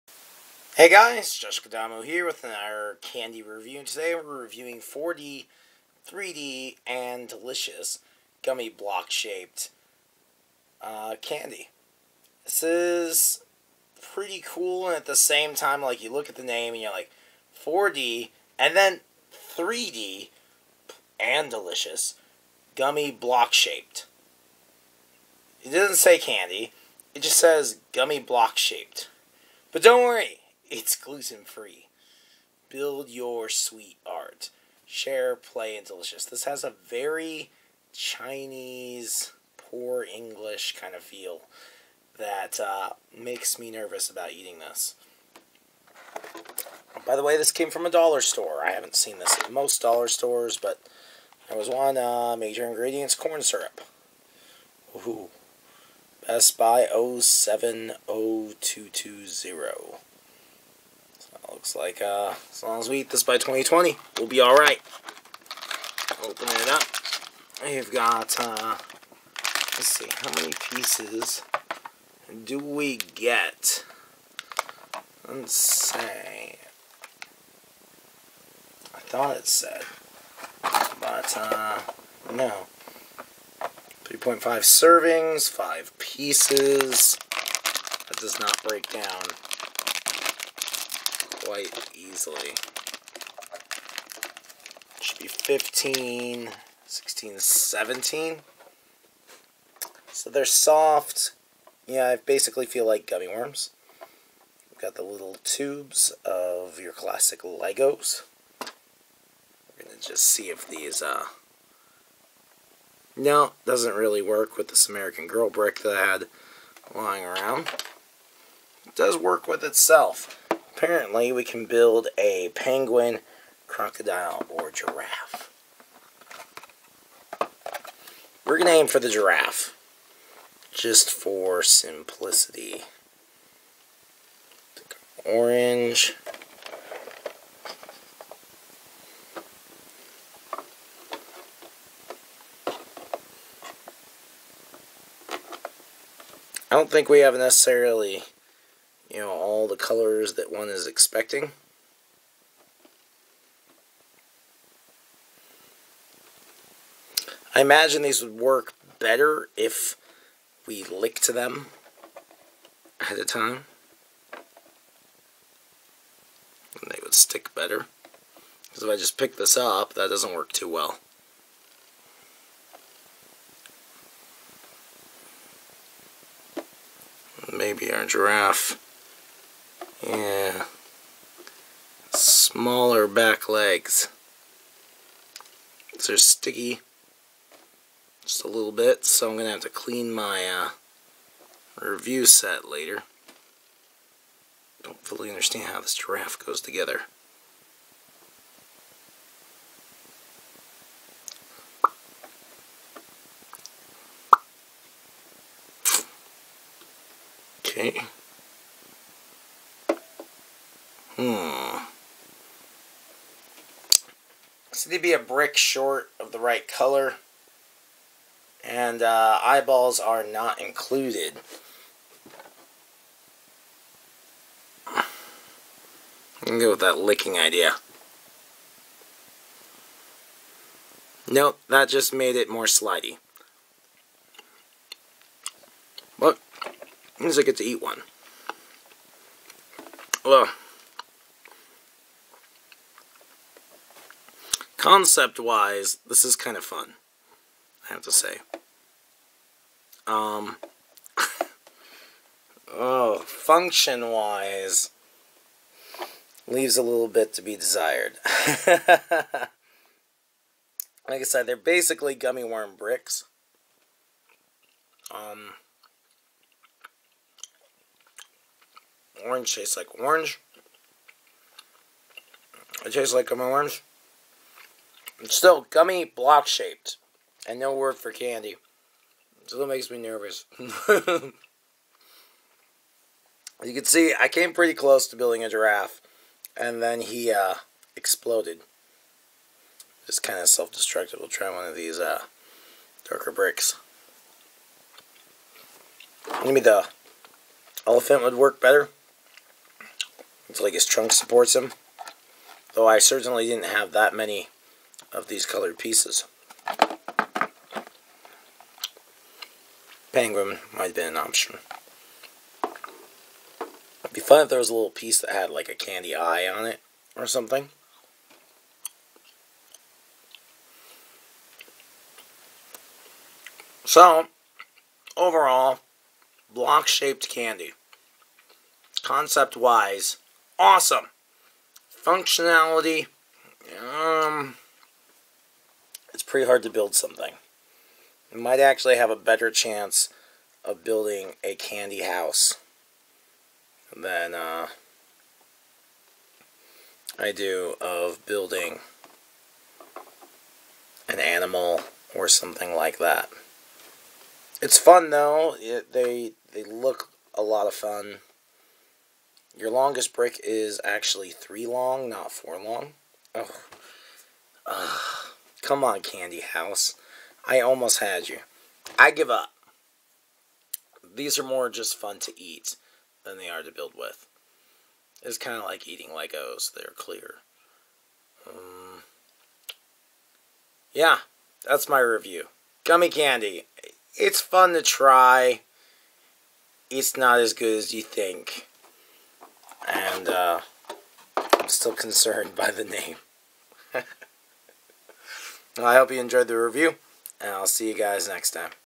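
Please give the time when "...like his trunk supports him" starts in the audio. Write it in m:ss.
5:00.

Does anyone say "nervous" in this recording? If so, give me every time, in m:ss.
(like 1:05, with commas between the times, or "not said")
0:43, 4:39.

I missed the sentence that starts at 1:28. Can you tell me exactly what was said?
That does not break down quite easily.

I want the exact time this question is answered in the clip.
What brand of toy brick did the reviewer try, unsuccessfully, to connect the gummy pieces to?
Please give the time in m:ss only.
1:54.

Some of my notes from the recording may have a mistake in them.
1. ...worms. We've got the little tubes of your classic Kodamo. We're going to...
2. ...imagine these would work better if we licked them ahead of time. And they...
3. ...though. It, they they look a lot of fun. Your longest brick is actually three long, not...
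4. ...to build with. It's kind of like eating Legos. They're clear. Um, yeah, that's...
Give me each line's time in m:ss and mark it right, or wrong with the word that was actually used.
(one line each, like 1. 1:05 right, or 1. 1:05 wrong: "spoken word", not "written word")
1. 1:43 wrong: "Legos", not "Kodamo"
2. 2:37 right
3. 5:55 right
4. 6:13 right.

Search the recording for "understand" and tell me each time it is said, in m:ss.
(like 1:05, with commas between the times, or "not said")
3:15.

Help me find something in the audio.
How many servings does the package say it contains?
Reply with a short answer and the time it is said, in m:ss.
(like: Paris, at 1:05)
3.5, at 1:24.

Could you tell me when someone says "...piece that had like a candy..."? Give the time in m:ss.
5:14.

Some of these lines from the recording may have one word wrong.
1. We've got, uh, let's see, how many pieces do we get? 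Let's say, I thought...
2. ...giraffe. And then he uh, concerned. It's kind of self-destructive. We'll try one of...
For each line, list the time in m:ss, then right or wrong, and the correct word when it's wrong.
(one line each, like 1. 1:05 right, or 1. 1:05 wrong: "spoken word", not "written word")
1. 1:07 right
2. 4:45 wrong: "exploded", not "concerned".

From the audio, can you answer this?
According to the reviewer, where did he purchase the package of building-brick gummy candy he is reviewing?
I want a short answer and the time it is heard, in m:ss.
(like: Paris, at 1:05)
a dollar store, at 0:47.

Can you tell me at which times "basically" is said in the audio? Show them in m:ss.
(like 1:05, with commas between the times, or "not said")
1:42, 4:21.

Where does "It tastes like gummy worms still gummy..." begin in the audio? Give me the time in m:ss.
4:32.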